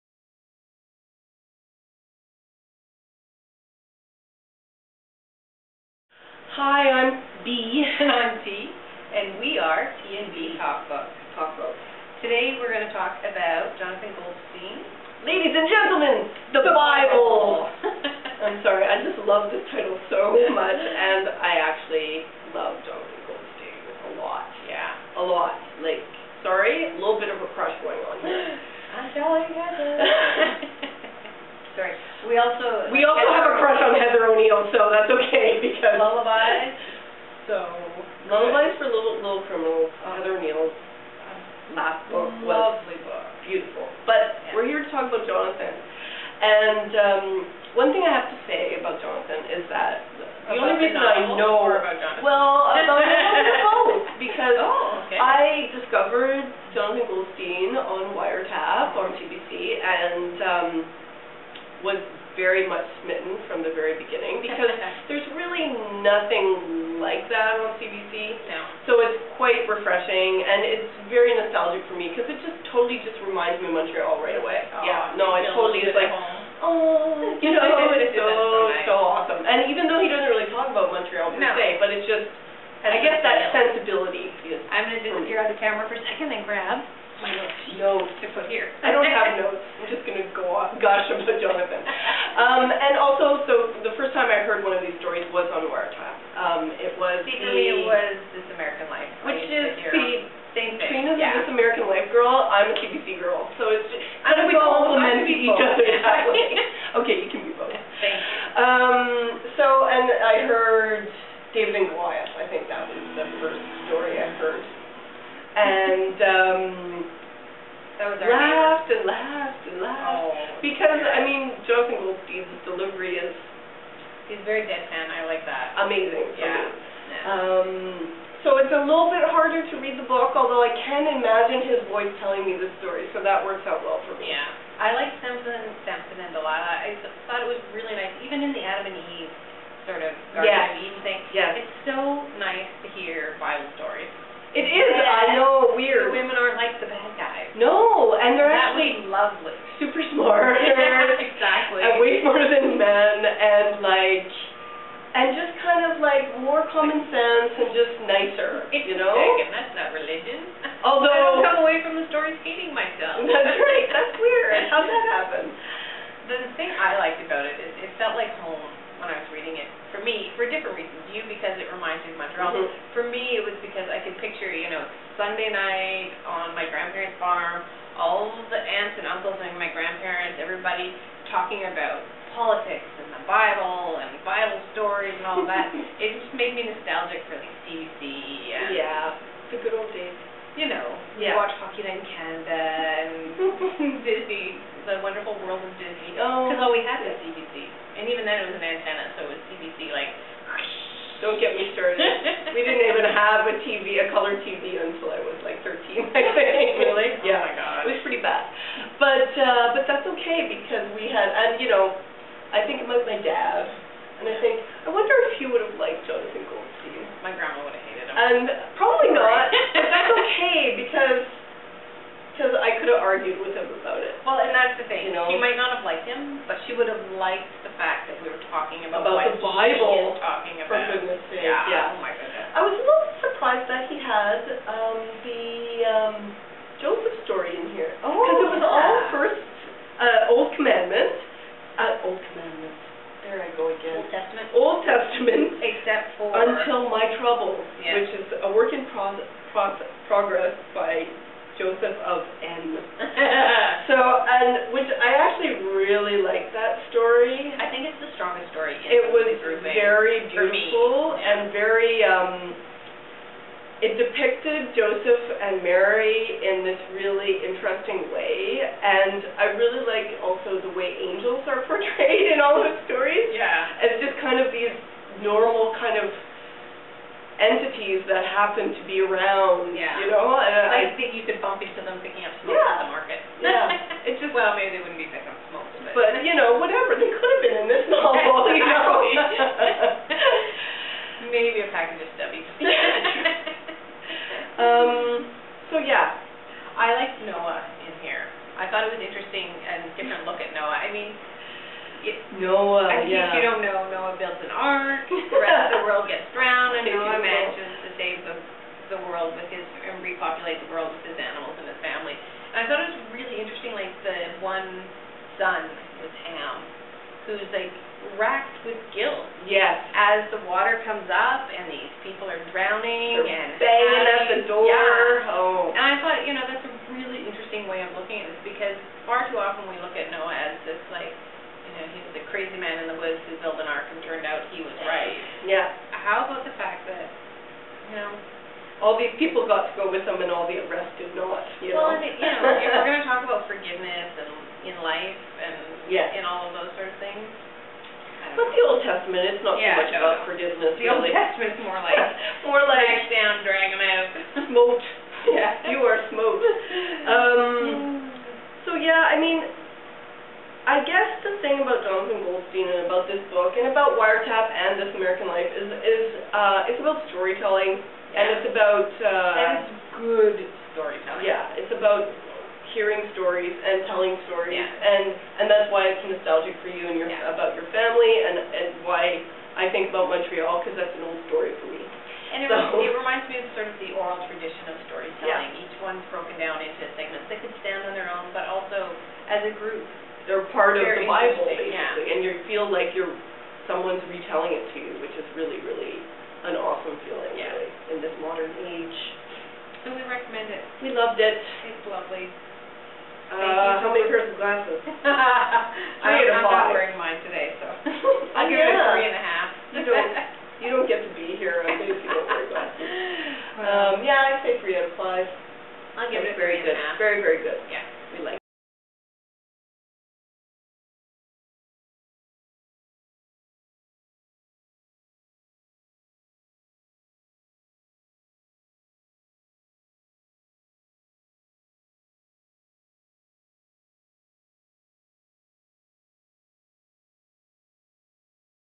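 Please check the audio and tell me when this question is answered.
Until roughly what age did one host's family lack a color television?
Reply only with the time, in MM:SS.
03:25.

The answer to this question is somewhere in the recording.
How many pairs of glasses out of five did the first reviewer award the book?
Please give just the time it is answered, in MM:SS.
06:48.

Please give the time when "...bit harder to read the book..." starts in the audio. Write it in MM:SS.
02:09.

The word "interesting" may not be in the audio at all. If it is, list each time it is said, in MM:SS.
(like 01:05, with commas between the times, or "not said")
04:27, 05:13, 05:27.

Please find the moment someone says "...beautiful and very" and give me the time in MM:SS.
04:20.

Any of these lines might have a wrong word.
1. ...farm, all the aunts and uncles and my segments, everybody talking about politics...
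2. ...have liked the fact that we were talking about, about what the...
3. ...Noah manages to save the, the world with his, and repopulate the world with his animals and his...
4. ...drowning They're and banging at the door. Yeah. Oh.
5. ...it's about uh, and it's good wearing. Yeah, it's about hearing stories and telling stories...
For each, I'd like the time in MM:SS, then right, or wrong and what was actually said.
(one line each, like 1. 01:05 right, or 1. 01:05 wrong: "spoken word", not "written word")
1. 02:57 wrong: "grandparents", not "segments"
2. 03:46 right
3. 05:06 right
4. 05:22 right
5. 06:08 wrong: "storytelling", not "wearing".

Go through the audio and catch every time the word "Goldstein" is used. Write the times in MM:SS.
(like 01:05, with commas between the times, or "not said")
00:14, 00:23, 00:57, 02:02, 03:36.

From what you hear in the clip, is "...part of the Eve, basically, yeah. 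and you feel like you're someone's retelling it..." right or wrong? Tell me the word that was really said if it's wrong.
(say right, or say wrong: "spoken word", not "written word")
wrong: "Bible", not "Eve".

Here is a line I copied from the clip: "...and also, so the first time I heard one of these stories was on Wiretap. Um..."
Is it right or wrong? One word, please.
right.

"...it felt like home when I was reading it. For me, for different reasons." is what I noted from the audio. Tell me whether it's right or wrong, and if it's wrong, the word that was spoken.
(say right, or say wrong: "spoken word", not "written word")
right.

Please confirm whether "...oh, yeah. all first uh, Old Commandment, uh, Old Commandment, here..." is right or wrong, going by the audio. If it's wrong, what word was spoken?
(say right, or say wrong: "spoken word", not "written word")
right.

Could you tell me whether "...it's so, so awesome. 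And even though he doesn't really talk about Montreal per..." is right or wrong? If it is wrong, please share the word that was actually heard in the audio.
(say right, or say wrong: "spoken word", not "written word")
right.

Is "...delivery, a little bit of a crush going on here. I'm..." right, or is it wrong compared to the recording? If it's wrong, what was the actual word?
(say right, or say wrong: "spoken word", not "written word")
wrong: "sorry", not "delivery".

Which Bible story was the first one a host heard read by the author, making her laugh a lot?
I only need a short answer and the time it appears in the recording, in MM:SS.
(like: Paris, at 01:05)
David and Goliath, at 01:51.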